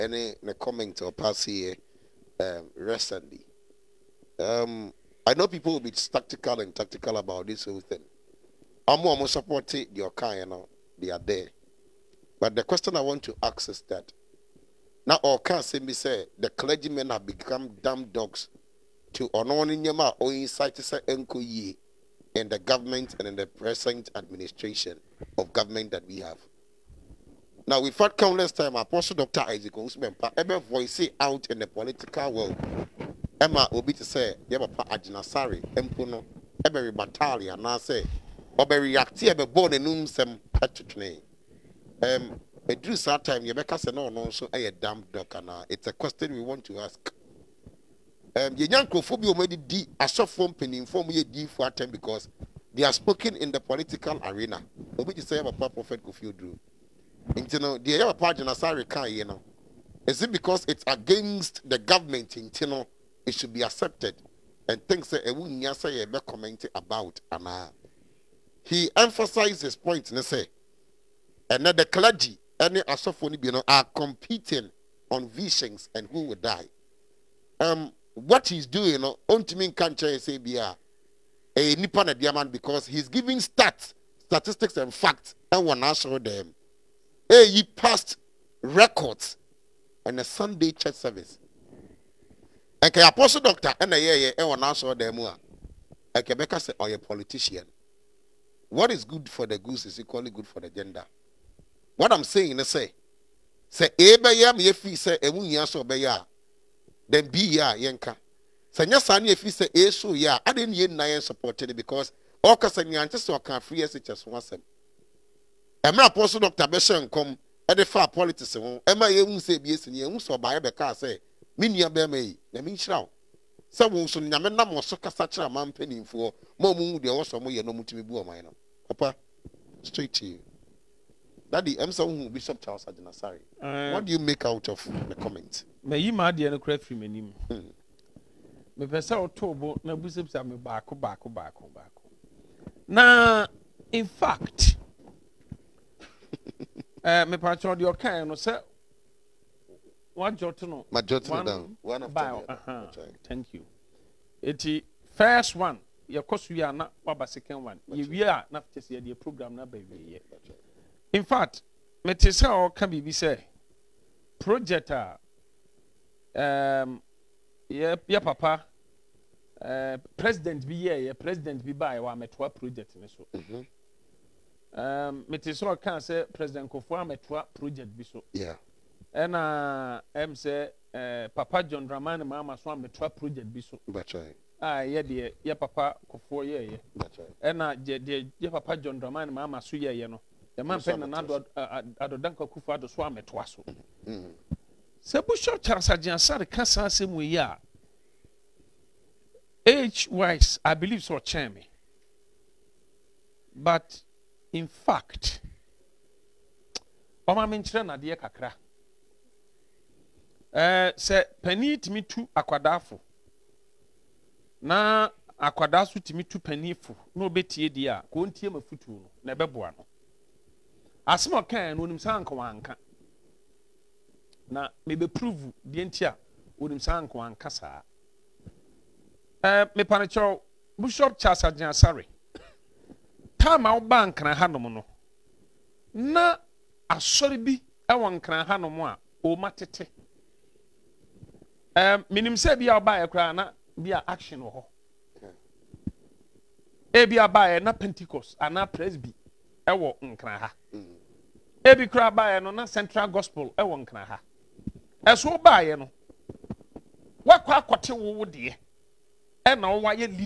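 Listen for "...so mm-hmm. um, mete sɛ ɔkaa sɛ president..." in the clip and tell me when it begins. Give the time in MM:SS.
02:53.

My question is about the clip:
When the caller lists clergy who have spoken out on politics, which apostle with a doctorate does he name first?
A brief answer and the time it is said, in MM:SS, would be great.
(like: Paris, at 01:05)
Isaac Owusu Bempa, at 00:29.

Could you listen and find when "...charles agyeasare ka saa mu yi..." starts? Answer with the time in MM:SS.
03:15.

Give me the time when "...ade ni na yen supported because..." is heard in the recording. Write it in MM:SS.
01:50.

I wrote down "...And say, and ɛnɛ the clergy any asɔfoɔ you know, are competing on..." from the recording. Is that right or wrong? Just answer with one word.
right.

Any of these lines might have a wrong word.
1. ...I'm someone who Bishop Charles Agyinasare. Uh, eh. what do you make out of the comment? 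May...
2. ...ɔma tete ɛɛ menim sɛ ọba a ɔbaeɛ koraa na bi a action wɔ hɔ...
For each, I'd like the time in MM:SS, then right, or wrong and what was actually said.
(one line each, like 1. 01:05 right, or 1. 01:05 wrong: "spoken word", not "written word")
1. 02:11 right
2. 03:59 right.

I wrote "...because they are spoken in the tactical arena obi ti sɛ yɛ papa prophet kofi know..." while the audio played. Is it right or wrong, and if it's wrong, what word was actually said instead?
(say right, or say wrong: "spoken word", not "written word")
wrong: "political", not "tactical".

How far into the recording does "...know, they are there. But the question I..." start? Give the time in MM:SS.
00:10.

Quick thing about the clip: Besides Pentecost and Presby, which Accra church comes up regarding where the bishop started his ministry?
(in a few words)
Central Gospel.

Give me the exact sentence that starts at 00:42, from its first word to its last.
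Um, during that time, Yabeka said, no, no, so I a damn duck, and uh, it's a question we want to ask.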